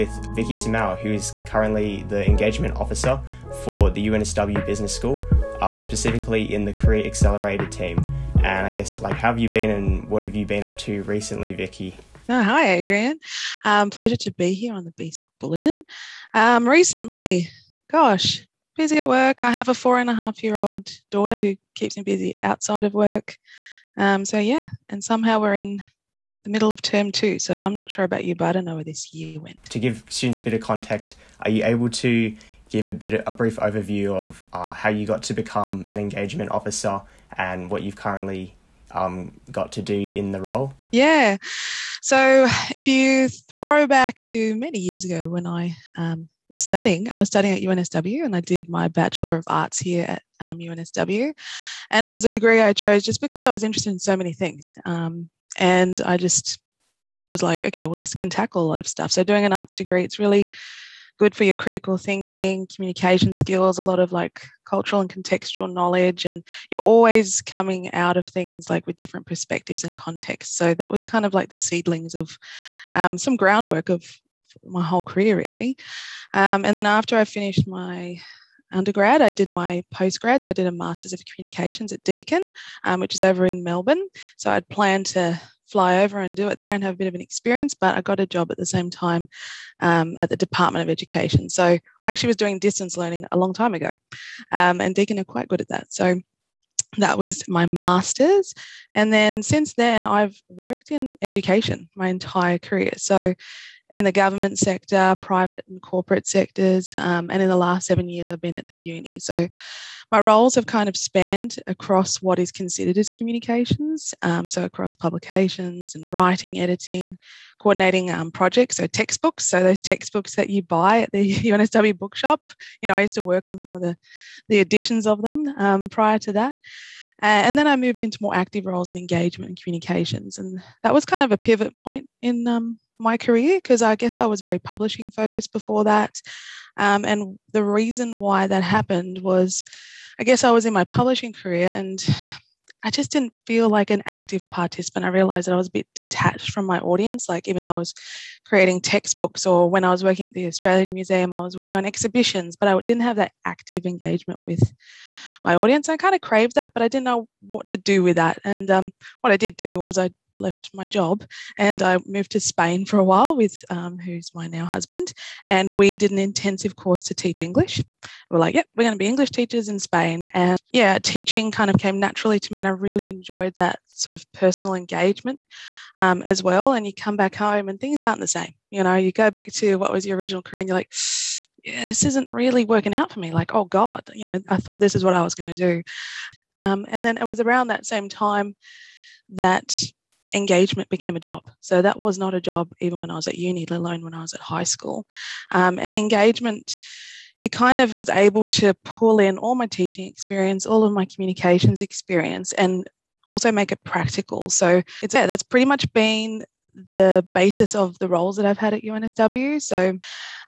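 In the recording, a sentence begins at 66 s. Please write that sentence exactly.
And you're always coming out of things like with different perspectives and contexts.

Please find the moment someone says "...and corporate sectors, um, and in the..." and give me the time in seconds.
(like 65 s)
105 s.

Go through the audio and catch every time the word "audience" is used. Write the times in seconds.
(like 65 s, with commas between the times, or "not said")
146 s, 155 s.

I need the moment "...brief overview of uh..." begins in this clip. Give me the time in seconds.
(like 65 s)
33 s.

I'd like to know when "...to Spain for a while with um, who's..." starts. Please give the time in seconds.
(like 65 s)
162 s.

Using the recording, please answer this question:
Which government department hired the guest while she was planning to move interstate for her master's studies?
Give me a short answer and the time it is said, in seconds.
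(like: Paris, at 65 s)
Department of Education, at 90 s.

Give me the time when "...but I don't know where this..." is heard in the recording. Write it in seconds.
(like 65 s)
28 s.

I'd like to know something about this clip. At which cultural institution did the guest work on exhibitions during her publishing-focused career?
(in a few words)
Australian Museum.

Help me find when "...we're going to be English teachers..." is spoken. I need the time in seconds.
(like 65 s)
168 s.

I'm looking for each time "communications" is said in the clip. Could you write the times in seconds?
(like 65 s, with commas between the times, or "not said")
62 s, 81 s, 113 s, 129 s, 201 s.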